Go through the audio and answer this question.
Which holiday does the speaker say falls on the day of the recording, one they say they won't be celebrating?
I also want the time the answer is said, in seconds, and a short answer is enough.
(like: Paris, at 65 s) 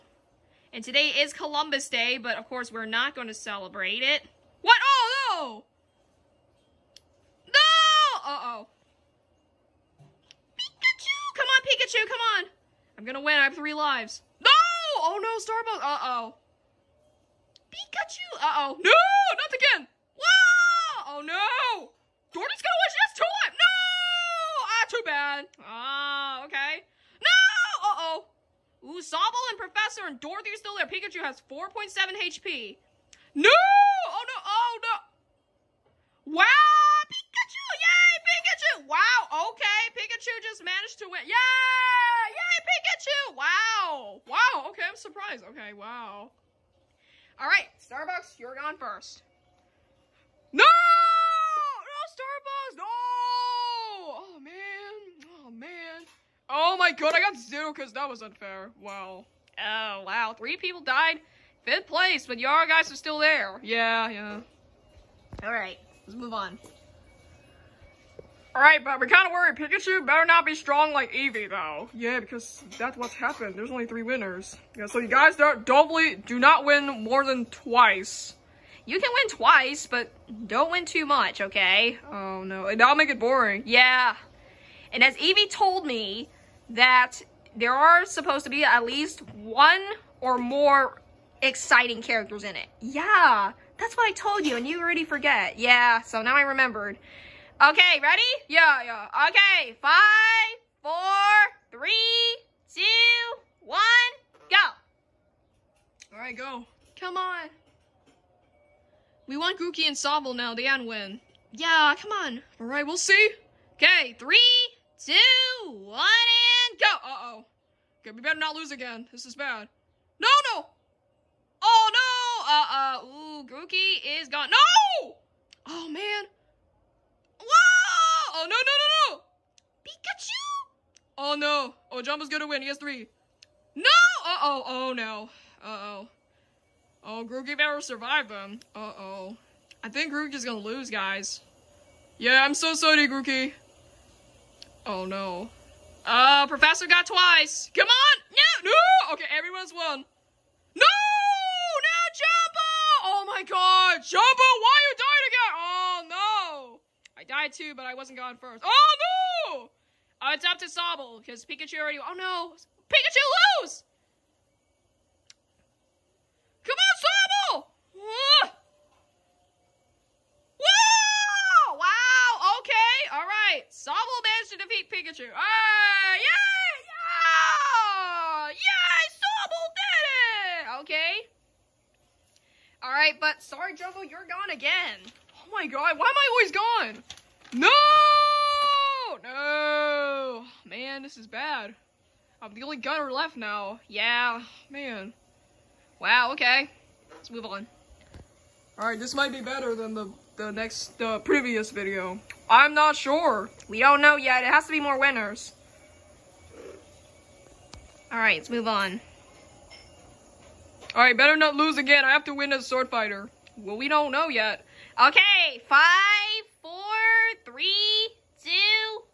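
Columbus Day, at 1 s.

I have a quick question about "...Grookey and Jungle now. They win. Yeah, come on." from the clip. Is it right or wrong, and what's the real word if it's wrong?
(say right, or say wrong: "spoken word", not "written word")
wrong: "Sobble", not "Jungle".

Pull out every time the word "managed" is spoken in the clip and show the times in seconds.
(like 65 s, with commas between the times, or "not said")
40 s, 174 s.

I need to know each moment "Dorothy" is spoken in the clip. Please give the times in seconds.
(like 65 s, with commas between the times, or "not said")
30 s.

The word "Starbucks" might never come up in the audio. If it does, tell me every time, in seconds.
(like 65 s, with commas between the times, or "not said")
15 s, 47 s, 52 s.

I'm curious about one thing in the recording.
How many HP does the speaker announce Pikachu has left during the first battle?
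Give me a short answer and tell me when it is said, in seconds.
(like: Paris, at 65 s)
4.7, at 31 s.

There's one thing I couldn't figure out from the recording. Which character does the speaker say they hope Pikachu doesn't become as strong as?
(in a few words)
Eevee.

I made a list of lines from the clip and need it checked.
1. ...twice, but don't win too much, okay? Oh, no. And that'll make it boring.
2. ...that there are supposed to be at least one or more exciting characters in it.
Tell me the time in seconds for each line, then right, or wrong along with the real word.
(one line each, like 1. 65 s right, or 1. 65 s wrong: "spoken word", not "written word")
1. 79 s right
2. 86 s right.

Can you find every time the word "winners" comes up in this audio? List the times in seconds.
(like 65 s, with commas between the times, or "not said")
74 s, 204 s.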